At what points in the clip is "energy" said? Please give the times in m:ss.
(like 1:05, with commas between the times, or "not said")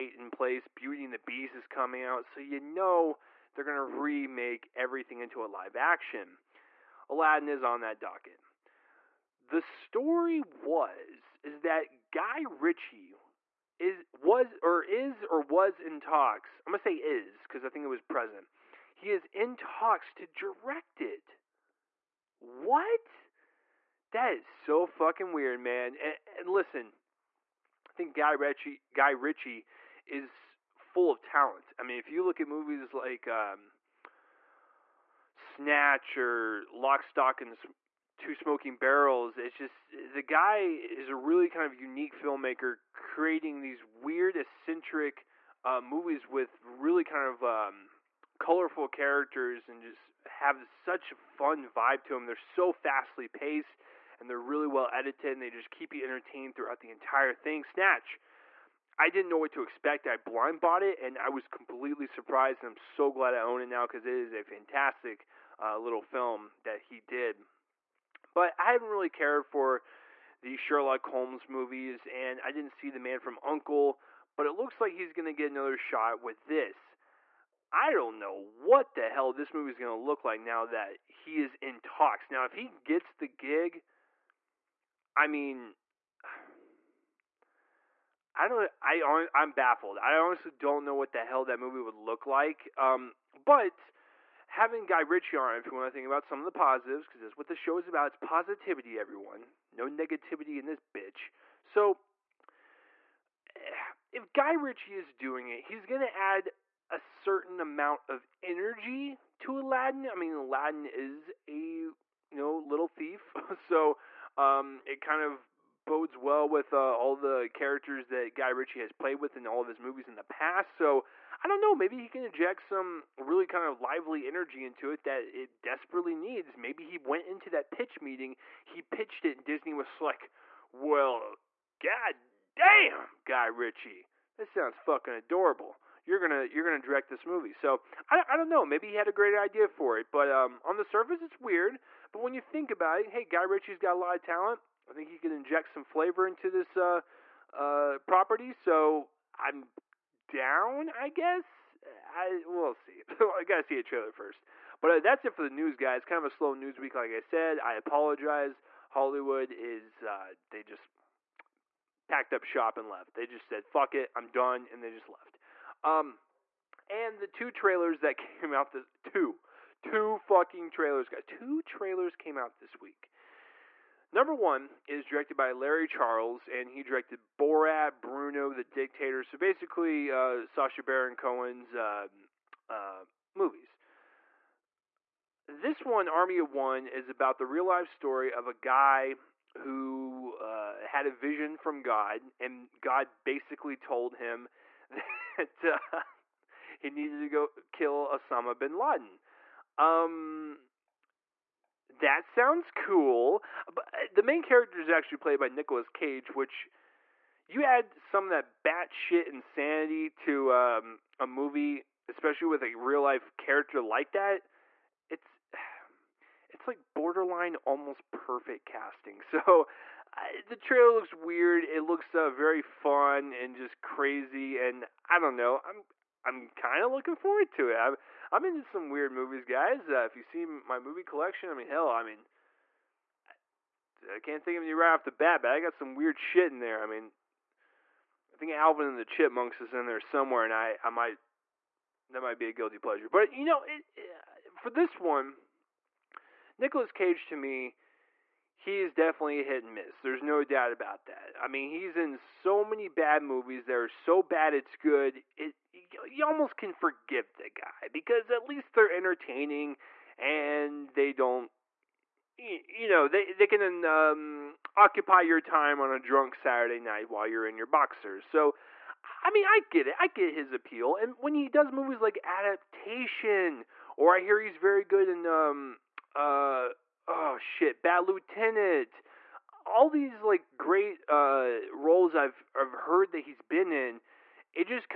1:48, 2:04.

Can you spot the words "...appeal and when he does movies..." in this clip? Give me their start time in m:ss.
4:30.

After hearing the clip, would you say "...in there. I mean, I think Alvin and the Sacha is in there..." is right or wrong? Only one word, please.
wrong.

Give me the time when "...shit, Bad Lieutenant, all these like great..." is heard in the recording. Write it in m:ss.
4:37.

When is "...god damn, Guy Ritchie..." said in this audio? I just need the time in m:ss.
2:11.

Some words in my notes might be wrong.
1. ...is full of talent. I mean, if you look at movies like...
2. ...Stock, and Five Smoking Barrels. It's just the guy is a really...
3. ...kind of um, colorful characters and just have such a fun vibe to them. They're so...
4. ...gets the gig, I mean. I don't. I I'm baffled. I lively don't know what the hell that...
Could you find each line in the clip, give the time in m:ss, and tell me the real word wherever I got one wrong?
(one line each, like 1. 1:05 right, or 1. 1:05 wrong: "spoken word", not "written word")
1. 0:30 right
2. 0:37 wrong: "Two", not "Five"
3. 0:47 right
4. 1:22 wrong: "honestly", not "lively".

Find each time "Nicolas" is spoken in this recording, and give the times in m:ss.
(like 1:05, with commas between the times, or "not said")
3:25, 4:06.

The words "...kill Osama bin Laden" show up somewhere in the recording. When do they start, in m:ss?
3:17.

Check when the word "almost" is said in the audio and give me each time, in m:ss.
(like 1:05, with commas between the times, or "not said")
3:37, 4:16.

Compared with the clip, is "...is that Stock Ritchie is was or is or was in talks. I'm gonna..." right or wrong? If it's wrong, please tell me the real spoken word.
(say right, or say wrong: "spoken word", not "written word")
wrong: "Guy", not "Stock".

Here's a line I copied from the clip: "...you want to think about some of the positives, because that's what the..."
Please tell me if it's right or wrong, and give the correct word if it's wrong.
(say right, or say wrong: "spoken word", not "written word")
right.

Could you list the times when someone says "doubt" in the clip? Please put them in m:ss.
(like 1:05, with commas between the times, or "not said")
4:10.